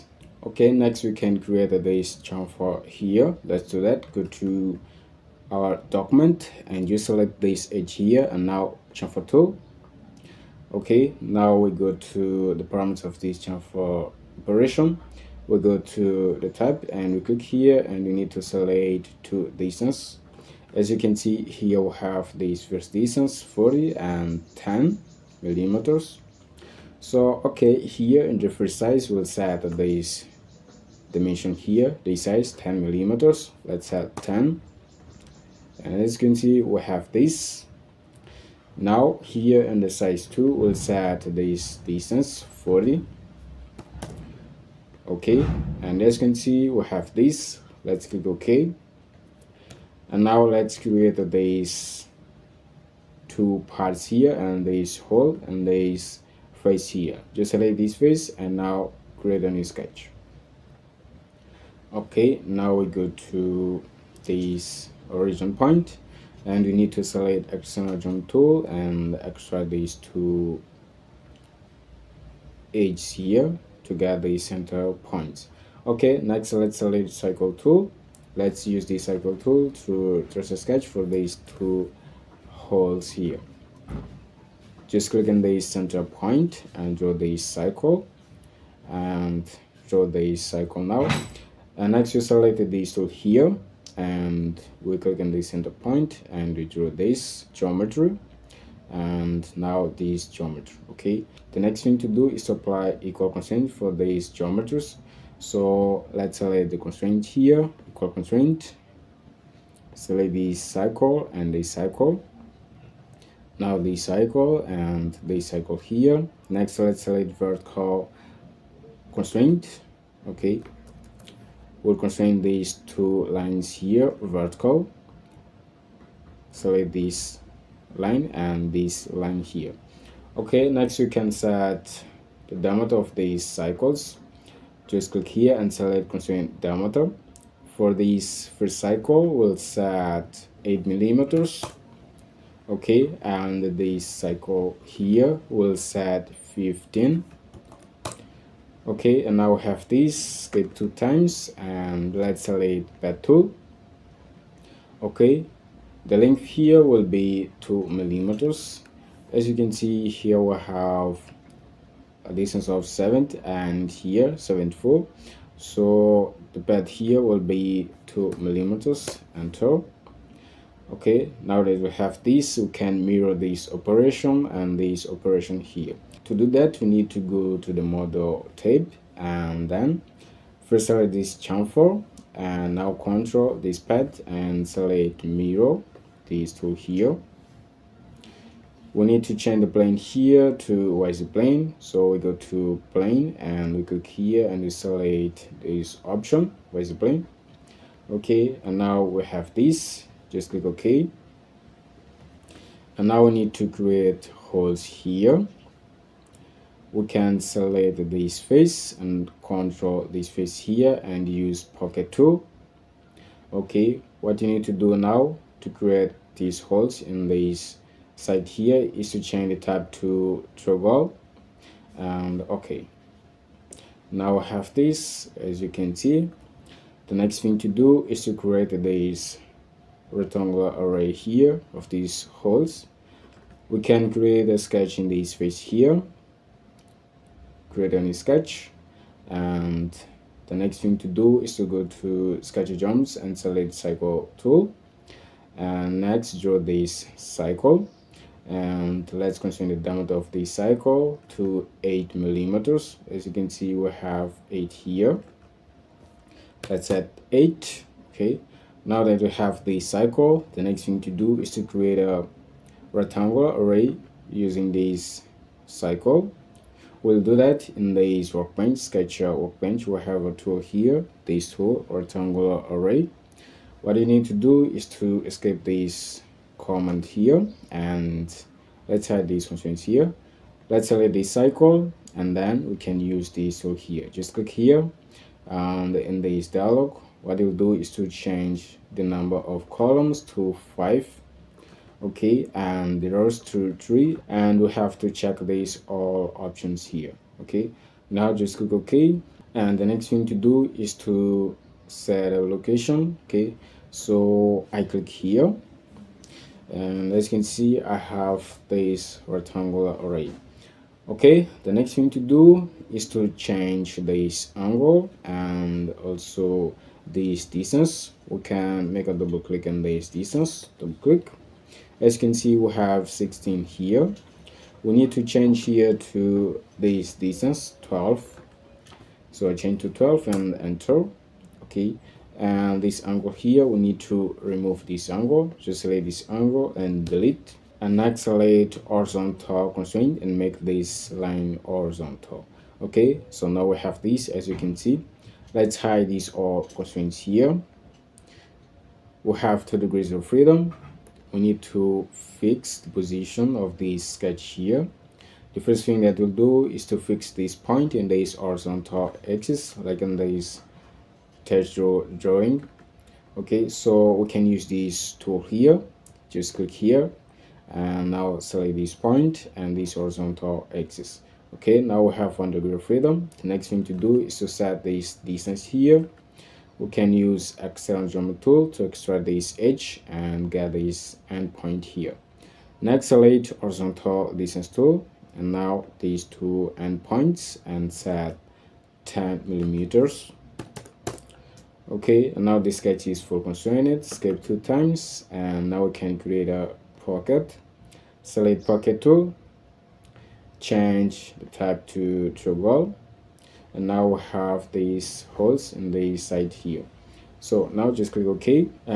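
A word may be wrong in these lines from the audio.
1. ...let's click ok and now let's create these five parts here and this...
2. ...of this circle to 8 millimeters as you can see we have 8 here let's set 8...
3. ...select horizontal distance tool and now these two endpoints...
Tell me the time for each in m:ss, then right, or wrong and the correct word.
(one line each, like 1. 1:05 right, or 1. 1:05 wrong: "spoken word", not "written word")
1. 0:47 wrong: "two", not "five"
2. 4:10 right
3. 6:23 right.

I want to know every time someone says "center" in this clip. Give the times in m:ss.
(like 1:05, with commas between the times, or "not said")
1:14, 1:25, 1:35.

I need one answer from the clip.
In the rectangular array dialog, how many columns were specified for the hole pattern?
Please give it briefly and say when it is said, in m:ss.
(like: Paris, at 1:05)
5, at 4:50.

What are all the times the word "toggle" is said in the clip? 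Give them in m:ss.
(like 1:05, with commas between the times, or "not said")
3:40, 6:42.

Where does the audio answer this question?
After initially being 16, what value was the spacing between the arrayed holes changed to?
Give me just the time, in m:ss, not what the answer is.
5:29.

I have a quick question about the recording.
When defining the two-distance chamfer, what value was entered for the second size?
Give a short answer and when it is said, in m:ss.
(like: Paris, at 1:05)
40, at 0:39.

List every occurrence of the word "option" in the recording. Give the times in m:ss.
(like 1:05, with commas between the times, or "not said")
3:16, 4:56.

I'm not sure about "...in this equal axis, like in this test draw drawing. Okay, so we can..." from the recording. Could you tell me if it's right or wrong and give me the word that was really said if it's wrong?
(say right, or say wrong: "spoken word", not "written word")
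wrong: "horizontal", not "equal".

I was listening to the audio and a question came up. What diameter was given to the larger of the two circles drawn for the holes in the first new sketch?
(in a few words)
15.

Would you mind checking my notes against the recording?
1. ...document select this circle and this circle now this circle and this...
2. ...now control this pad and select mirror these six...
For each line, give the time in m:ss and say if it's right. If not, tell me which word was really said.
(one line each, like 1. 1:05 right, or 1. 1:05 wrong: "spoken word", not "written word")
1. 1:48 wrong: "constraint", not "document"
2. 3:02 wrong: "two", not "six".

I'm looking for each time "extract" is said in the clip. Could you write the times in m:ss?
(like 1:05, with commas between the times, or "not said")
1:09, 6:18.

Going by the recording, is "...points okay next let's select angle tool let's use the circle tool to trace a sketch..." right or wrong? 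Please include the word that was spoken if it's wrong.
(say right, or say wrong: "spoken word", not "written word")
wrong: "circle", not "angle".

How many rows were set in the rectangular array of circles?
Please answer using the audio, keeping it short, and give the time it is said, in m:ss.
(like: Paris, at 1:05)
3, at 4:53.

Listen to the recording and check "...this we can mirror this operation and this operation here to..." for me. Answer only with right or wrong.
right.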